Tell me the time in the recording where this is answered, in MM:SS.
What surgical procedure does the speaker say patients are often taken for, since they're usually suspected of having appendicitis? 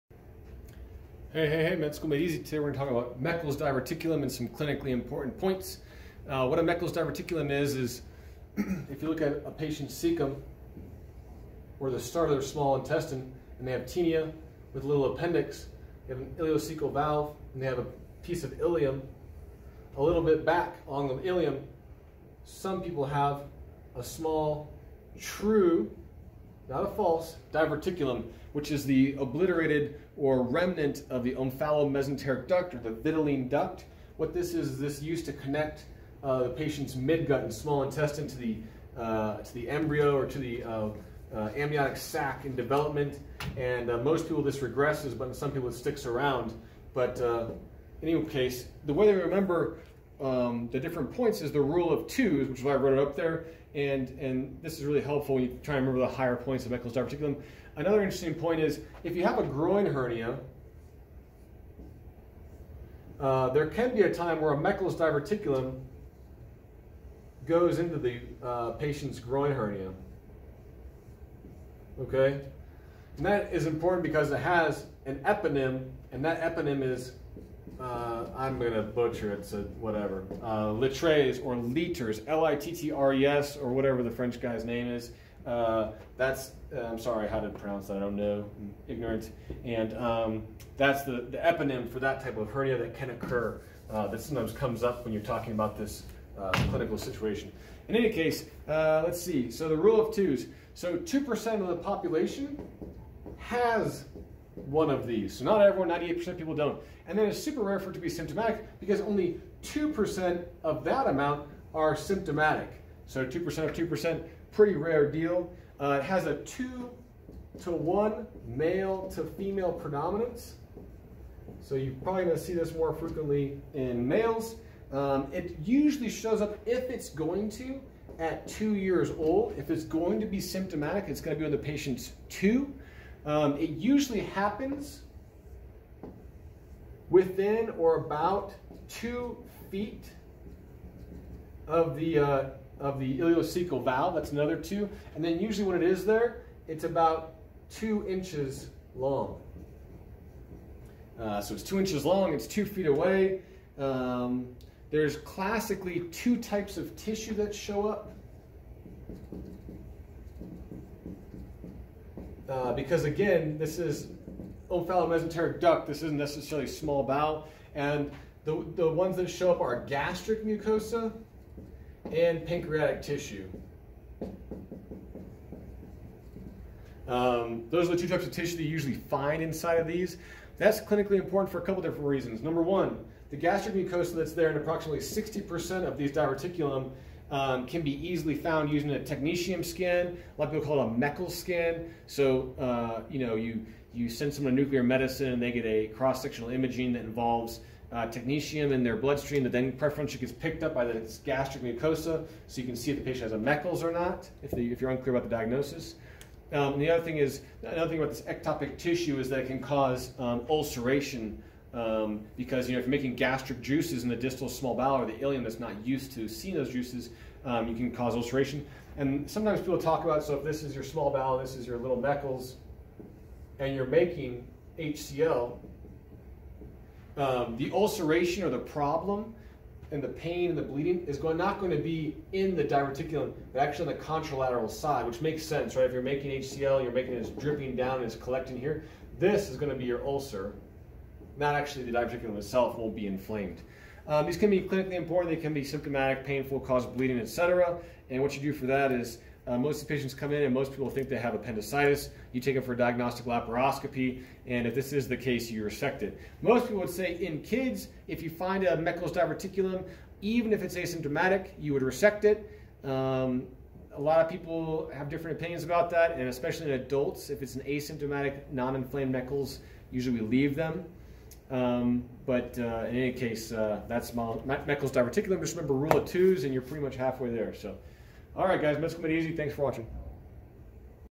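04:12.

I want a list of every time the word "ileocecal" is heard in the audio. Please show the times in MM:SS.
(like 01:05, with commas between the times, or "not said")
00:16, 02:23.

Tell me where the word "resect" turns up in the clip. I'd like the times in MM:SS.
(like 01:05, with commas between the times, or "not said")
04:15, 04:21.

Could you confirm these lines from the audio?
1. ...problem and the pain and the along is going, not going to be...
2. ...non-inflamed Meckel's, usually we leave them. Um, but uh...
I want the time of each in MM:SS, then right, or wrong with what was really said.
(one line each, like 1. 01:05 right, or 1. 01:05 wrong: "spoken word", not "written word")
1. 03:48 wrong: "bleeding", not "along"
2. 04:28 right.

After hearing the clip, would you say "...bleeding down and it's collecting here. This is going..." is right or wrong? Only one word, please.
wrong.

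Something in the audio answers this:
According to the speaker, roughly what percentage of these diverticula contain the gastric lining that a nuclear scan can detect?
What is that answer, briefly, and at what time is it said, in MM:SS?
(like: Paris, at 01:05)
60%, at 03:04.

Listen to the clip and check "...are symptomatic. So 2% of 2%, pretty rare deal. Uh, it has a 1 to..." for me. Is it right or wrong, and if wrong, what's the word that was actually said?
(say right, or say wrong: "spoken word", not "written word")
wrong: "2", not "1".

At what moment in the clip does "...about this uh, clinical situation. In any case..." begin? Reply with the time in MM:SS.
01:35.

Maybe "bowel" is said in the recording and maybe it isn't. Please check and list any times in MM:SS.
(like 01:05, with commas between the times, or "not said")
02:47, 03:34, 03:41.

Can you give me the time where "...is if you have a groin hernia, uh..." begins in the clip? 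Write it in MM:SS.
00:58.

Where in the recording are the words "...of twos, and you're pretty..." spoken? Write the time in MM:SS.
04:35.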